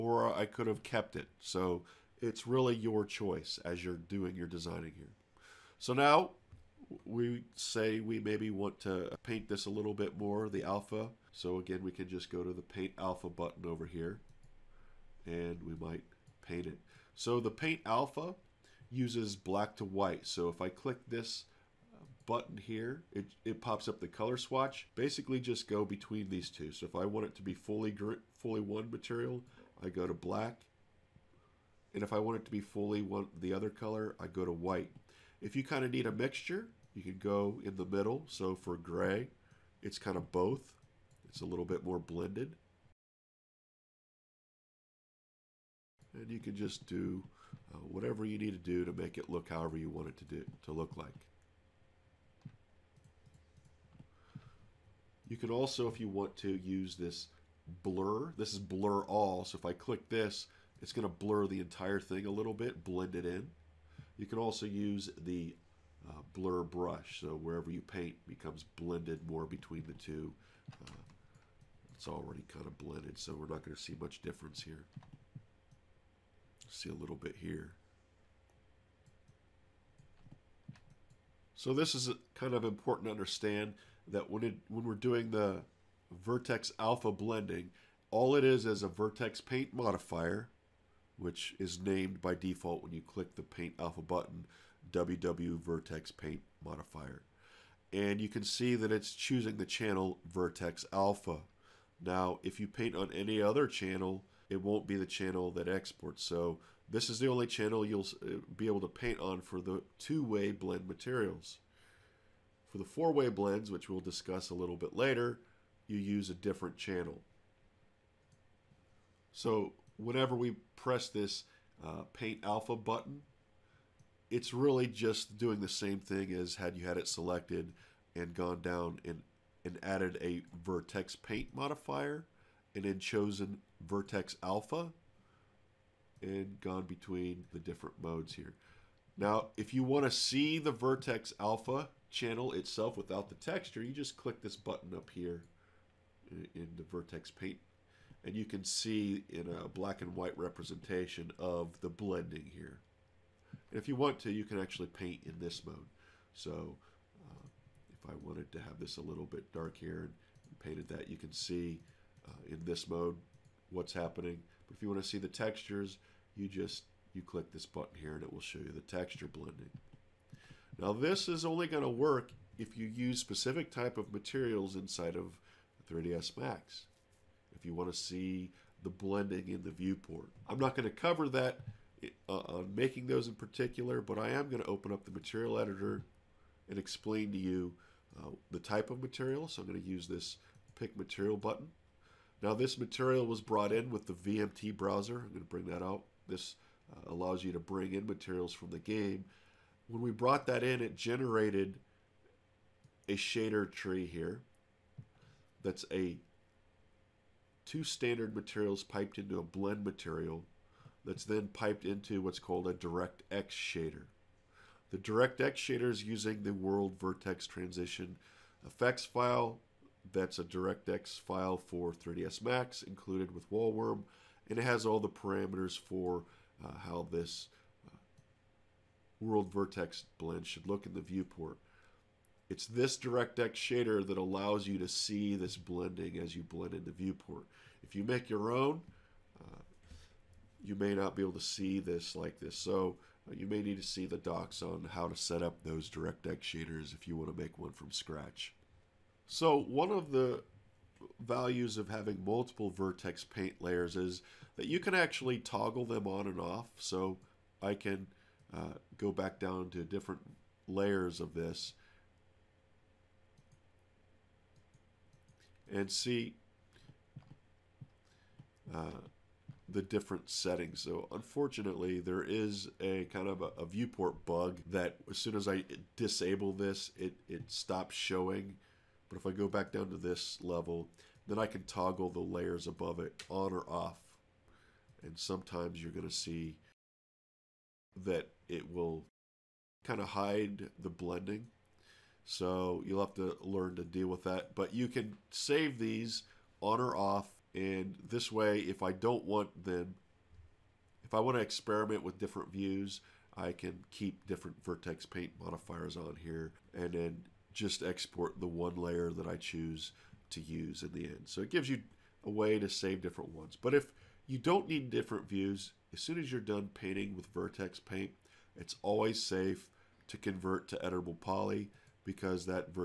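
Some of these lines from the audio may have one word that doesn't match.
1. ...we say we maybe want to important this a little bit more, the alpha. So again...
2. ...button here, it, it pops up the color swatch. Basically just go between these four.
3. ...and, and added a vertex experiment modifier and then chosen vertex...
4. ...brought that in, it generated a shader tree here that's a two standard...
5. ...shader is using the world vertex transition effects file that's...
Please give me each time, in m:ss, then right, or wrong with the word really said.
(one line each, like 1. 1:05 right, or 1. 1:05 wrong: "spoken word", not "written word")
1. 0:07 wrong: "paint", not "important"
2. 0:22 wrong: "two", not "four"
3. 2:09 wrong: "paint", not "experiment"
4. 3:20 right
5. 3:35 right.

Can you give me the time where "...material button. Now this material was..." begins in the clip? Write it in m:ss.
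3:10.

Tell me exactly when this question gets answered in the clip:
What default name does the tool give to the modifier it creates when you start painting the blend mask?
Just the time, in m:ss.
1:34.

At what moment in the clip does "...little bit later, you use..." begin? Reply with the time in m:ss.
1:54.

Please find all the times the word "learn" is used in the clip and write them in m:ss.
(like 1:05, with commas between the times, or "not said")
4:53.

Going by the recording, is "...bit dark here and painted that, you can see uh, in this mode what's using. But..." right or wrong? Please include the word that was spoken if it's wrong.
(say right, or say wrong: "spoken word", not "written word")
wrong: "happening", not "using".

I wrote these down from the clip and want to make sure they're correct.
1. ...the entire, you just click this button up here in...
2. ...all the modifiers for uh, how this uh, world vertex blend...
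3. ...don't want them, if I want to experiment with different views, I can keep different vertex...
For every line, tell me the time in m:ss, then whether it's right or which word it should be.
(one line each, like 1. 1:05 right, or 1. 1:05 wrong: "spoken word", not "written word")
1. 2:23 wrong: "texture", not "entire"
2. 3:44 wrong: "parameters", not "modifiers"
3. 4:58 right.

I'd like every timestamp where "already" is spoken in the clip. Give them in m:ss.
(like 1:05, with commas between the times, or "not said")
1:12.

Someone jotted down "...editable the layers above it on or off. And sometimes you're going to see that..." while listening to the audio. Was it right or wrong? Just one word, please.
wrong.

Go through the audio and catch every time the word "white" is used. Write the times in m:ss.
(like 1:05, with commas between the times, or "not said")
0:19, 0:34, 2:30.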